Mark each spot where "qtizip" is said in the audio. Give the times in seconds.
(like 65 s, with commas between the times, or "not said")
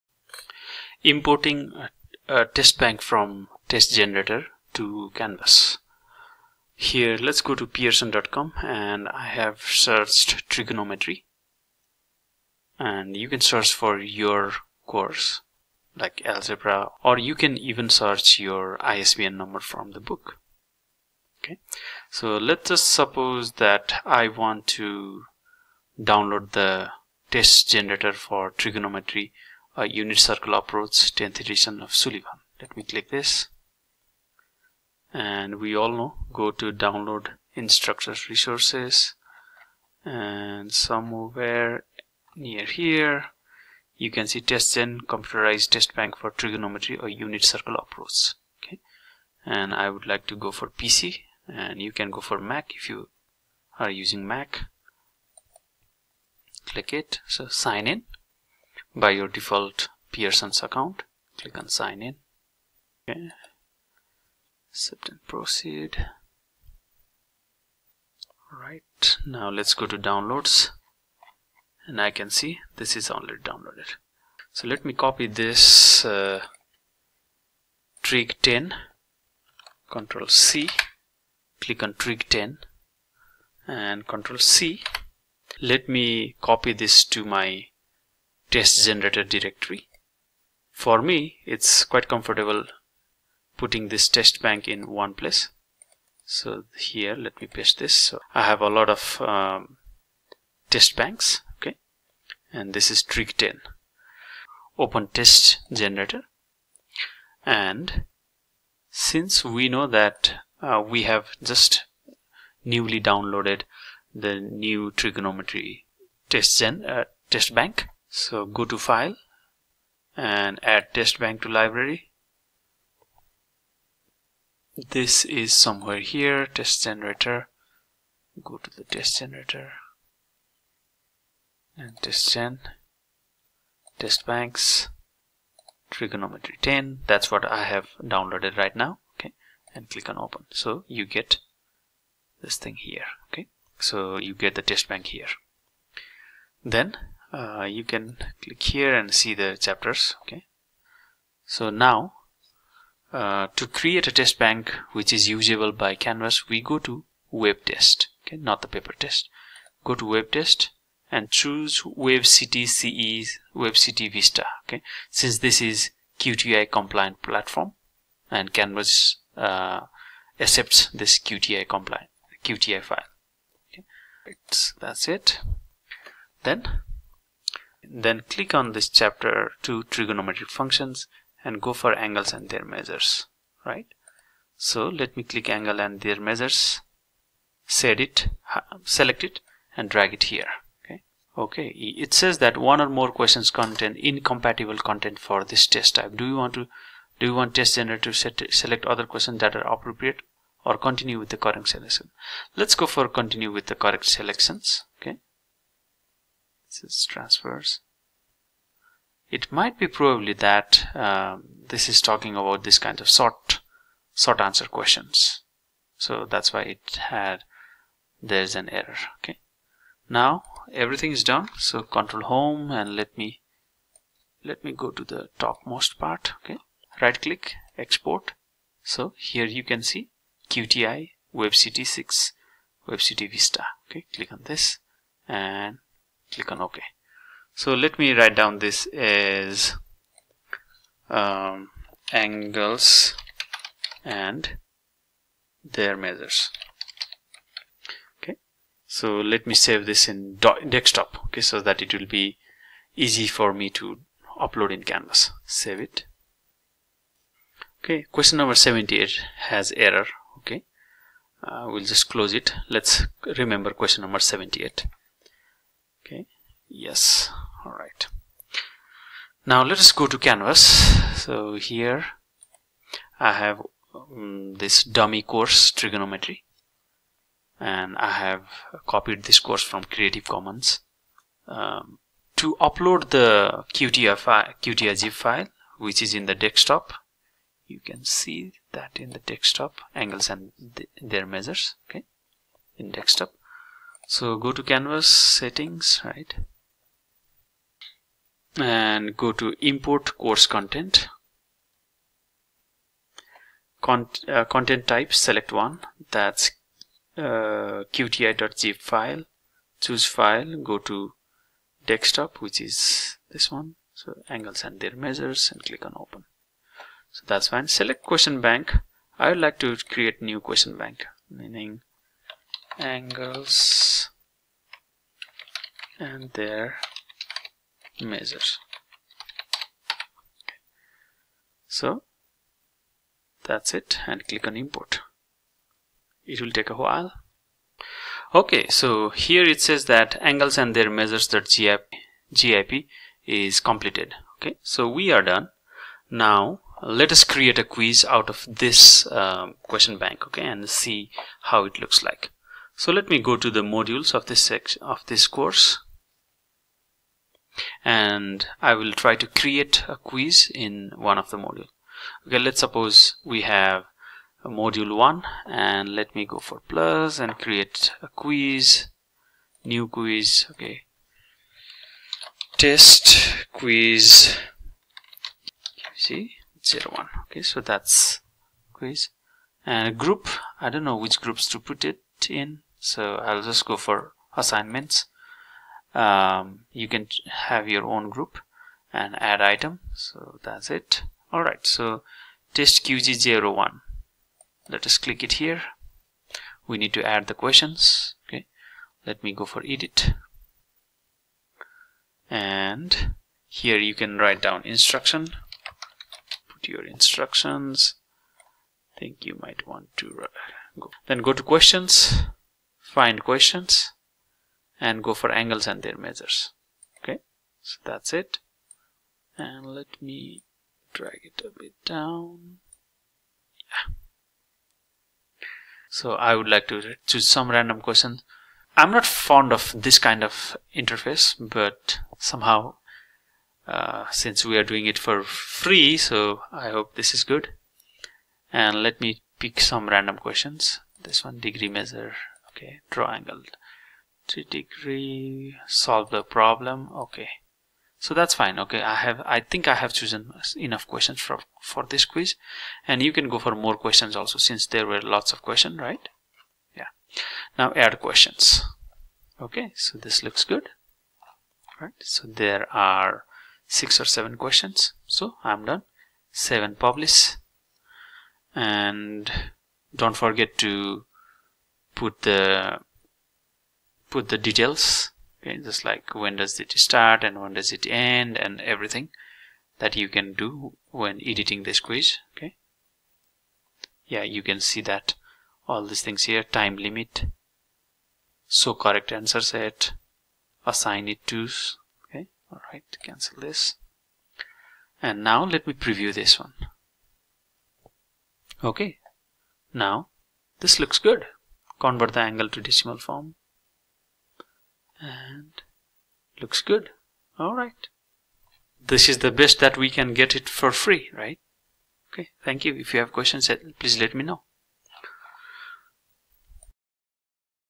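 307 s.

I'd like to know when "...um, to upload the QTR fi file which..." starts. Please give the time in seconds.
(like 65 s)
281 s.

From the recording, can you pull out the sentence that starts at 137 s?
That's what I have downloaded right now.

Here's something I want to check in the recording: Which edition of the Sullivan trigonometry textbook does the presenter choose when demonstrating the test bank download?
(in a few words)
10th edition.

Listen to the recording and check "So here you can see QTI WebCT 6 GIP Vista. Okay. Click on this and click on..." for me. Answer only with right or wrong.
wrong.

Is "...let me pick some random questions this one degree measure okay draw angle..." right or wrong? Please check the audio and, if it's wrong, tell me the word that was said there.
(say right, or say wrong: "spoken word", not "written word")
right.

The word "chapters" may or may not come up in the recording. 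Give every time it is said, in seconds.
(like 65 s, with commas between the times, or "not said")
149 s, 178 s.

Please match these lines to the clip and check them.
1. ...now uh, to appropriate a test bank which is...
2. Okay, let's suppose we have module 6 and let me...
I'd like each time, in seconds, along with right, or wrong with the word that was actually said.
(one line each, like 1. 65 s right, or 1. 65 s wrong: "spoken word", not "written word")
1. 151 s wrong: "create", not "appropriate"
2. 362 s wrong: "1", not "6".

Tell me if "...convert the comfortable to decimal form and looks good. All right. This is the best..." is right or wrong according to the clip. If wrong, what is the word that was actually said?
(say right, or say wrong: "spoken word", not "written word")
wrong: "angle", not "comfortable".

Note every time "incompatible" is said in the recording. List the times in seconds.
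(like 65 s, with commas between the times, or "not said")
193 s.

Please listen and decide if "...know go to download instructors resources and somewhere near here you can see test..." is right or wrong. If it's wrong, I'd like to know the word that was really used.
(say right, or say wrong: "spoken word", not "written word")
right.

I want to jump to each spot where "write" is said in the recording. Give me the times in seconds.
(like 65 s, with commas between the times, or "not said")
238 s, 404 s.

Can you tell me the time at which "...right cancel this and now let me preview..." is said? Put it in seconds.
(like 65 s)
492 s.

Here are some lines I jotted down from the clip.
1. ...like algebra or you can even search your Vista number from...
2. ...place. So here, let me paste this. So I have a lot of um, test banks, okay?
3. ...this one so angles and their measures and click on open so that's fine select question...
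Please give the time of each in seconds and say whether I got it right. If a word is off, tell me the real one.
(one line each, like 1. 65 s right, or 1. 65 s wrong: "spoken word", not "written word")
1. 15 s wrong: "ISBN", not "Vista"
2. 95 s right
3. 313 s right.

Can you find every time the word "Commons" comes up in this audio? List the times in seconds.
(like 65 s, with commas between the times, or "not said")
280 s.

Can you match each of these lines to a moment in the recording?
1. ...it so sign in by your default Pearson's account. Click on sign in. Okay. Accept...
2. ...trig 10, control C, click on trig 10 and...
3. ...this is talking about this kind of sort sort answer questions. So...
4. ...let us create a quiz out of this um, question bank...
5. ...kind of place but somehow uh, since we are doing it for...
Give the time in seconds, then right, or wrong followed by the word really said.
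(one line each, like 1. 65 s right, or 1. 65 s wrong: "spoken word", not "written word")
1. 56 s right
2. 78 s right
3. 211 s right
4. 346 s right
5. 429 s wrong: "interface", not "place".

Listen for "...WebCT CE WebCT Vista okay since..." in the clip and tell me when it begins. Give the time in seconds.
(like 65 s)
161 s.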